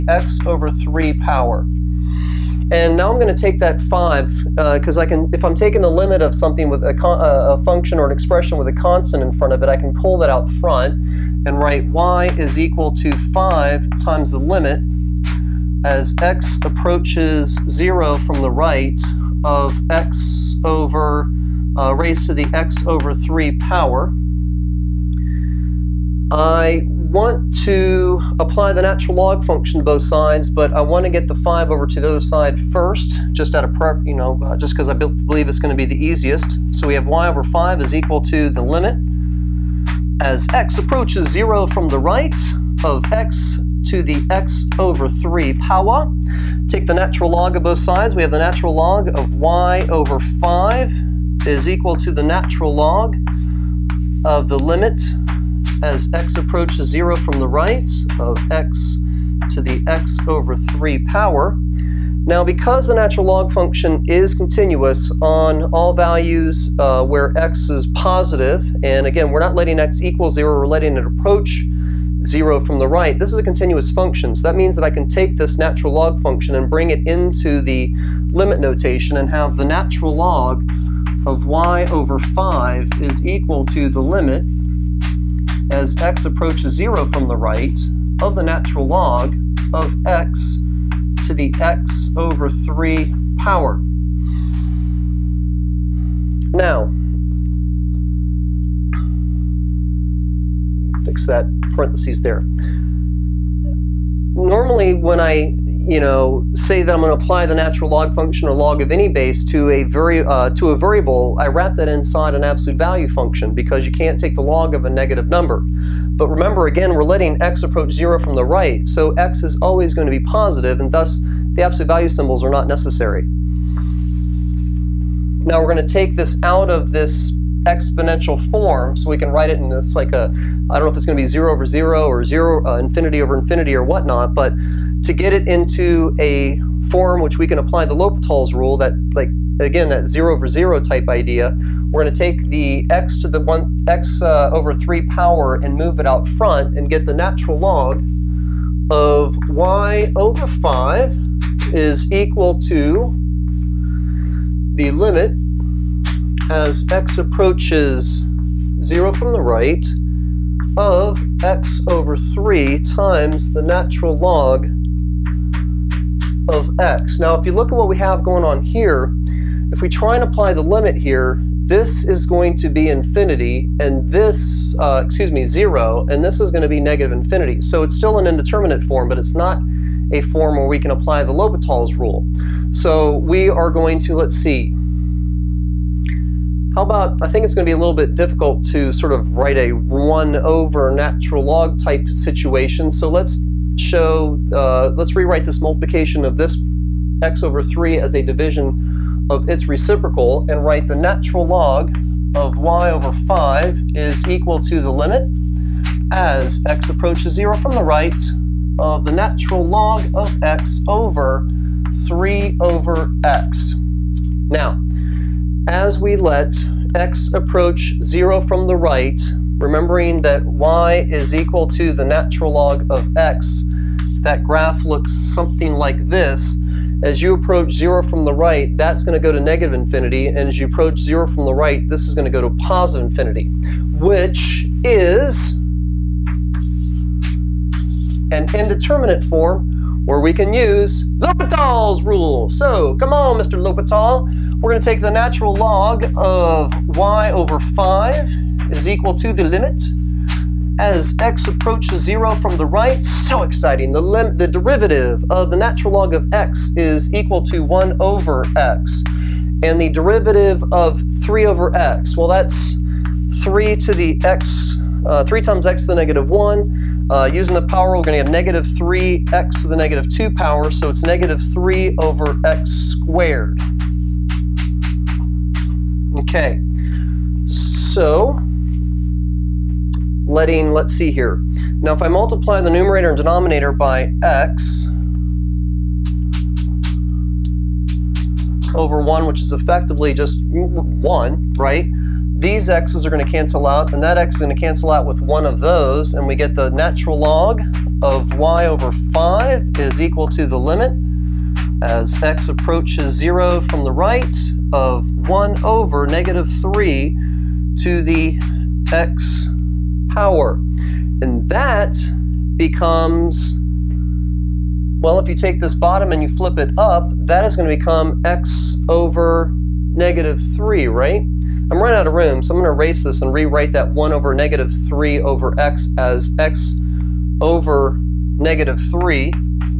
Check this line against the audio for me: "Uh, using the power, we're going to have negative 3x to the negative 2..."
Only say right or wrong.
right.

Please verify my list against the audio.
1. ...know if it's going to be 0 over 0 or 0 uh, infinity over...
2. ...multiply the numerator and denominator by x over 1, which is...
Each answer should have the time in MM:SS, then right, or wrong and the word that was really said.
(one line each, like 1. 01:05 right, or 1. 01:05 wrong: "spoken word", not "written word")
1. 02:10 right
2. 04:42 right.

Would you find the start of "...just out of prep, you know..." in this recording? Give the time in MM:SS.
00:33.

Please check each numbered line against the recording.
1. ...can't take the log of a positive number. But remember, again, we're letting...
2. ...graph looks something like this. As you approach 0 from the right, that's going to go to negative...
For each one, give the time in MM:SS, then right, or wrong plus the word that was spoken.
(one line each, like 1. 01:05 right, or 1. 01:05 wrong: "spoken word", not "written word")
1. 01:53 wrong: "negative", not "positive"
2. 03:44 right.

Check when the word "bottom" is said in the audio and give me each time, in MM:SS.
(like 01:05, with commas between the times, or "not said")
05:15.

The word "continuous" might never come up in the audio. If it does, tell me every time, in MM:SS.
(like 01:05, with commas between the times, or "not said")
01:04, 01:13.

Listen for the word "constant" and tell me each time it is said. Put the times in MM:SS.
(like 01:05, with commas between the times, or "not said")
00:08.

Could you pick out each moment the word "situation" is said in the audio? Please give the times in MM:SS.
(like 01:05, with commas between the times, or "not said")
03:12.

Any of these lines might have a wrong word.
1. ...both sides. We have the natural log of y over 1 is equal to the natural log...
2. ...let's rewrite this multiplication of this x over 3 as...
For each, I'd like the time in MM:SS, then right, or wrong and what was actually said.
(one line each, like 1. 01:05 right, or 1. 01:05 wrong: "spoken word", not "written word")
1. 00:47 wrong: "5", not "1"
2. 03:14 right.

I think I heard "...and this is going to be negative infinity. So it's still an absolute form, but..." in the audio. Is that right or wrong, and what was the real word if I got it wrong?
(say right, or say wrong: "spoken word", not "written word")
wrong: "indeterminate", not "absolute".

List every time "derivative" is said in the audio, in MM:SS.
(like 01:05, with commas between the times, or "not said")
04:14, 04:19.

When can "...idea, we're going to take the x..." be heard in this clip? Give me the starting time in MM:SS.
02:21.